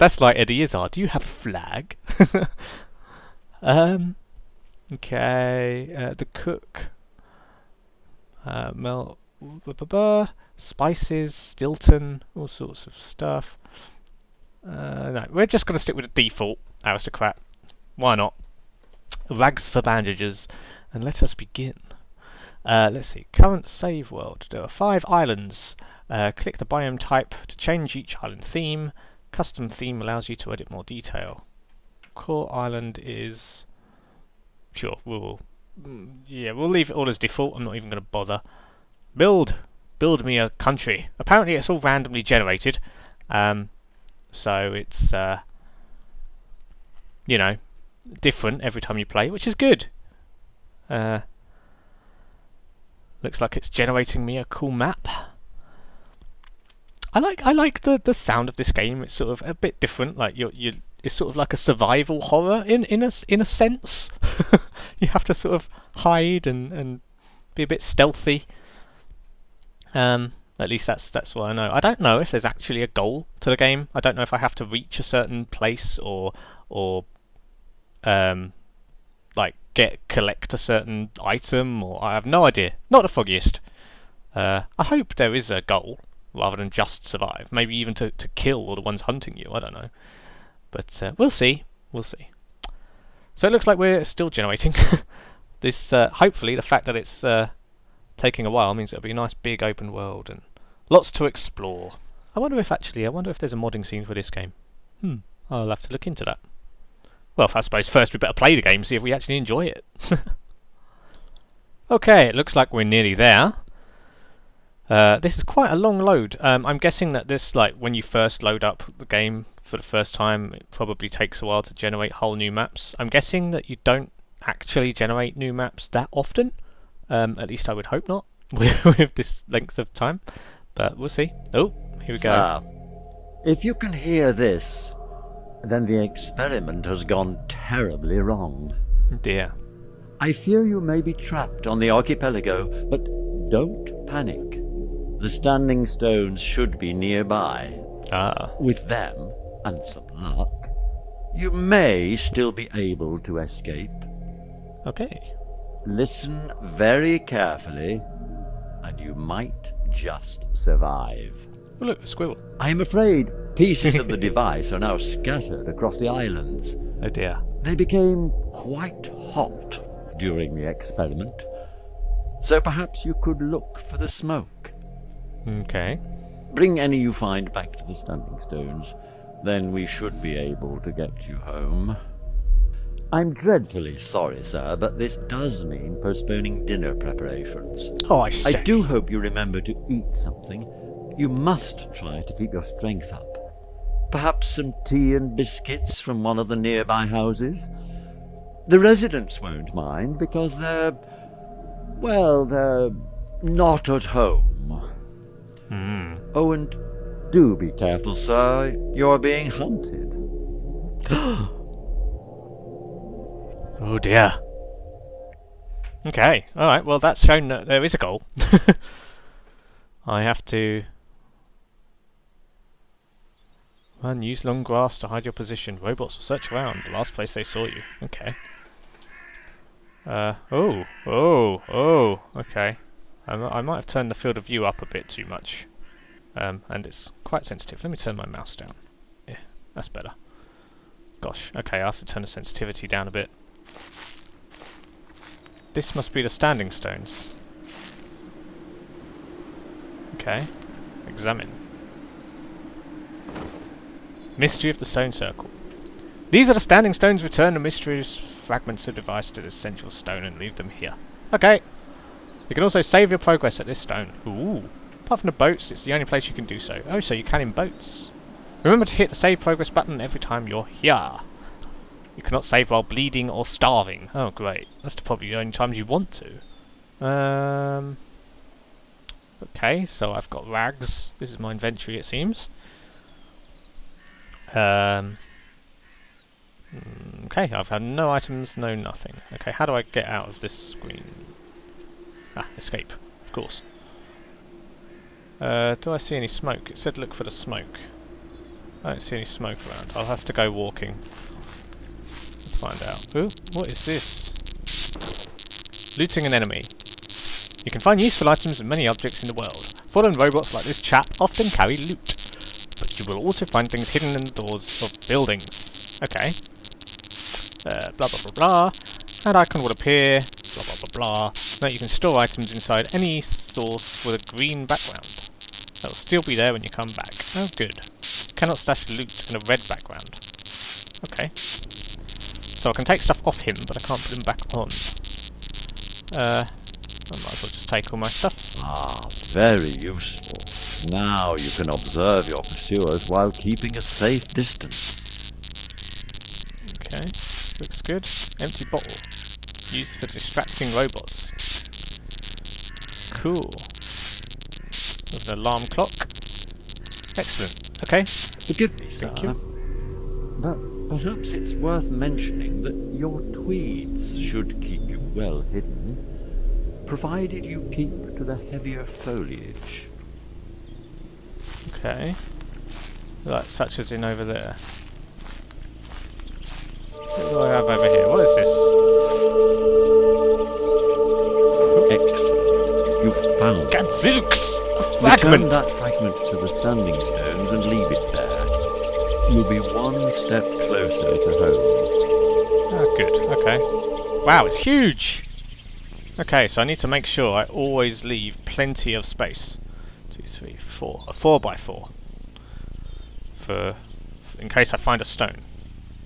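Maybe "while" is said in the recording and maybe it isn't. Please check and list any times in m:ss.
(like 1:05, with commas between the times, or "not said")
1:38, 2:01, 4:32, 5:43.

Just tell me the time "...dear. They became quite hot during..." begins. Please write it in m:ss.
2:47.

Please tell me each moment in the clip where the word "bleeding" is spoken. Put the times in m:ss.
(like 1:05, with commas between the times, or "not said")
4:32.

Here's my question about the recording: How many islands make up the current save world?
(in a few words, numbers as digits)
5.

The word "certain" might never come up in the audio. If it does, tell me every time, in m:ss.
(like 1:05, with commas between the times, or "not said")
1:15, 1:20.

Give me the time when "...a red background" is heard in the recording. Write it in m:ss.
5:29.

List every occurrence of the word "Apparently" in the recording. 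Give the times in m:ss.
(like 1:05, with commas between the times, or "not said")
0:41.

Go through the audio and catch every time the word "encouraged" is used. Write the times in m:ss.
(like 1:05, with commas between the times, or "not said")
not said.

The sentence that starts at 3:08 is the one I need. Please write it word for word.
I do hope you remember to eat something.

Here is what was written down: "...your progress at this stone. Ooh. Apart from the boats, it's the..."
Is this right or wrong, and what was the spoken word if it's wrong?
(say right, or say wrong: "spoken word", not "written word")
right.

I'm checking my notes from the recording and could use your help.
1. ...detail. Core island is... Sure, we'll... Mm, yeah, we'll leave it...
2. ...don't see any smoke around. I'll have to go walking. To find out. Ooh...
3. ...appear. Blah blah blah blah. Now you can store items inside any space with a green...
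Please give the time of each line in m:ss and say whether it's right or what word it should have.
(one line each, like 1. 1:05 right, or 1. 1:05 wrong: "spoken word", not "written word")
1. 0:30 right
2. 4:58 right
3. 5:19 wrong: "source", not "space".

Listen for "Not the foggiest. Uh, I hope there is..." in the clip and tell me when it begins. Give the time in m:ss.
1:22.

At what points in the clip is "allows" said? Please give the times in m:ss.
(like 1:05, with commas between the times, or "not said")
0:30.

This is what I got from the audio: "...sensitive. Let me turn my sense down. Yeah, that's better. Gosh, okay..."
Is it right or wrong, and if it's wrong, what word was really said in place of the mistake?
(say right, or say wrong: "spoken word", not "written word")
wrong: "mouse", not "sense".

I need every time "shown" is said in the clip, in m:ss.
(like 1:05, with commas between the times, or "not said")
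3:37.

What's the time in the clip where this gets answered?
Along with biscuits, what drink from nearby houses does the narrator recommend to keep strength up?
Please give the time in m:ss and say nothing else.
3:14.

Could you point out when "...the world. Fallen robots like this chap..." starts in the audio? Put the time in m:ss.
5:09.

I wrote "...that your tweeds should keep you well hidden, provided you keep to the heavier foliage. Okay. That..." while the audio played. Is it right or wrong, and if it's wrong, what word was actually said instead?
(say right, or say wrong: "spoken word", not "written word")
right.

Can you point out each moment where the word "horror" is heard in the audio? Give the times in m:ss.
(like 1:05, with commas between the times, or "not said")
1:02.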